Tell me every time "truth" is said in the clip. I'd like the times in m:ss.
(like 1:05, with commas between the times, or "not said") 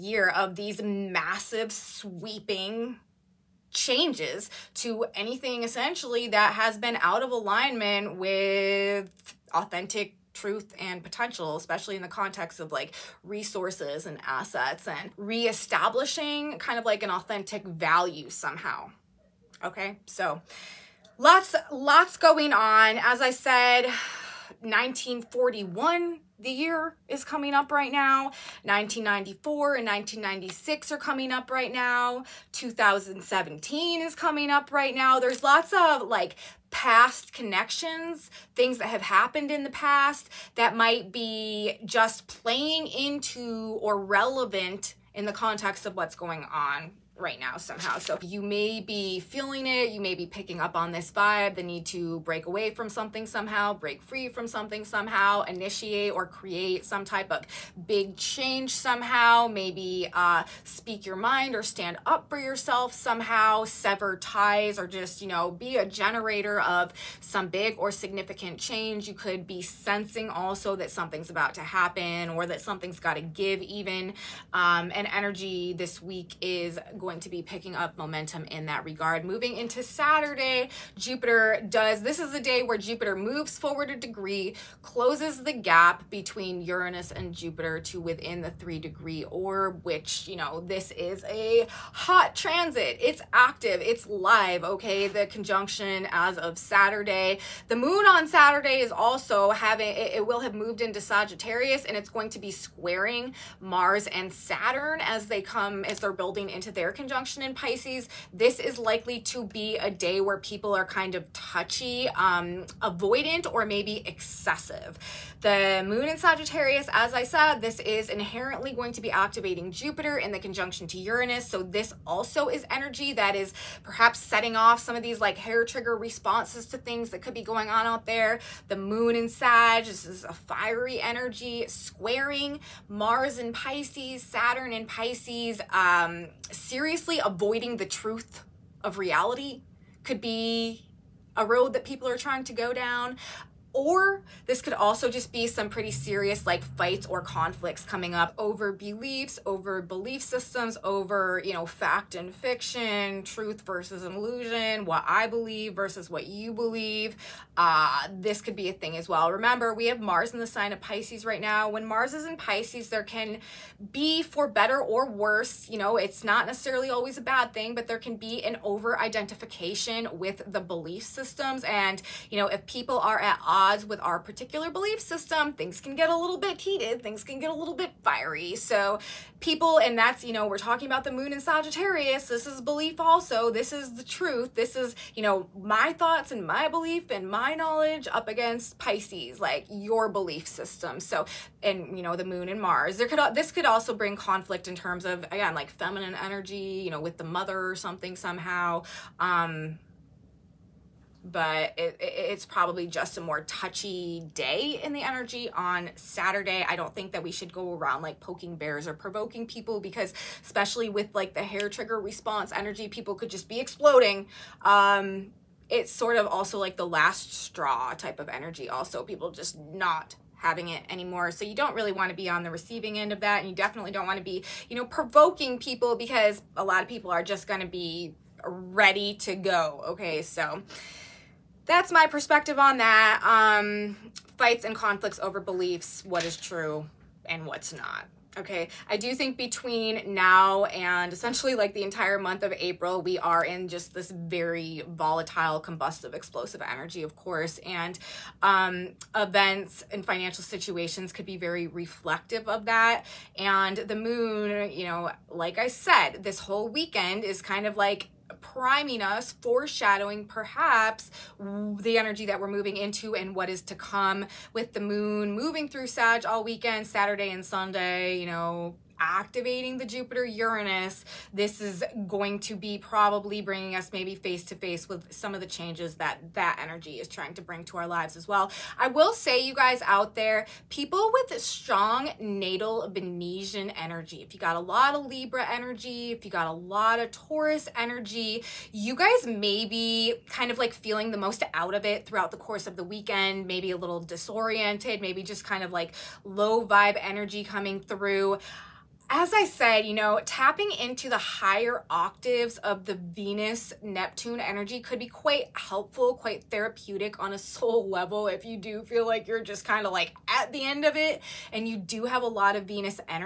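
0:10, 2:17, 2:33, 3:04.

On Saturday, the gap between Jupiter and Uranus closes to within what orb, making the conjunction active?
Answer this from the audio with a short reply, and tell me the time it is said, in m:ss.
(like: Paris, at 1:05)
3 degrees, at 1:28.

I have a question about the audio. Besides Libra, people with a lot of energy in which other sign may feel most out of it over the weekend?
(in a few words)
Taurus.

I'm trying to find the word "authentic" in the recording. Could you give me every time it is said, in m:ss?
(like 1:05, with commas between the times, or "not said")
0:09, 0:17.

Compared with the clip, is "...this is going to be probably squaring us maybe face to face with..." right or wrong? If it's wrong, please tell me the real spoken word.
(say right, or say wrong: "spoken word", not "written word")
wrong: "bringing", not "squaring".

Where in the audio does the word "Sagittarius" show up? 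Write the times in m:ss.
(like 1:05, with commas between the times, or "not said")
1:41, 1:56, 3:01.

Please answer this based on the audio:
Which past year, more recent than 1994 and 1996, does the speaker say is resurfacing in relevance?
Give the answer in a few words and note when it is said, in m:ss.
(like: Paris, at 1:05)
2017, at 0:32.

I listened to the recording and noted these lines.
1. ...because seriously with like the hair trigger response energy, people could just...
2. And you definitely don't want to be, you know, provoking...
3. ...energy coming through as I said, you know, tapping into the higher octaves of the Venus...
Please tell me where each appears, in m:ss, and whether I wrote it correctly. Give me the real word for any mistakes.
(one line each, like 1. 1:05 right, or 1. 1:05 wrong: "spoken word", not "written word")
1. 3:29 wrong: "especially", not "seriously"
2. 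3:43 right
3. 4:57 right.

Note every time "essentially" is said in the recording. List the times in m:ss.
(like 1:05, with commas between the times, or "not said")
0:05, 4:01.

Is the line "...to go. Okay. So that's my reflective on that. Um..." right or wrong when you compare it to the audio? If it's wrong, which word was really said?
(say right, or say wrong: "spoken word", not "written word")
wrong: "perspective", not "reflective".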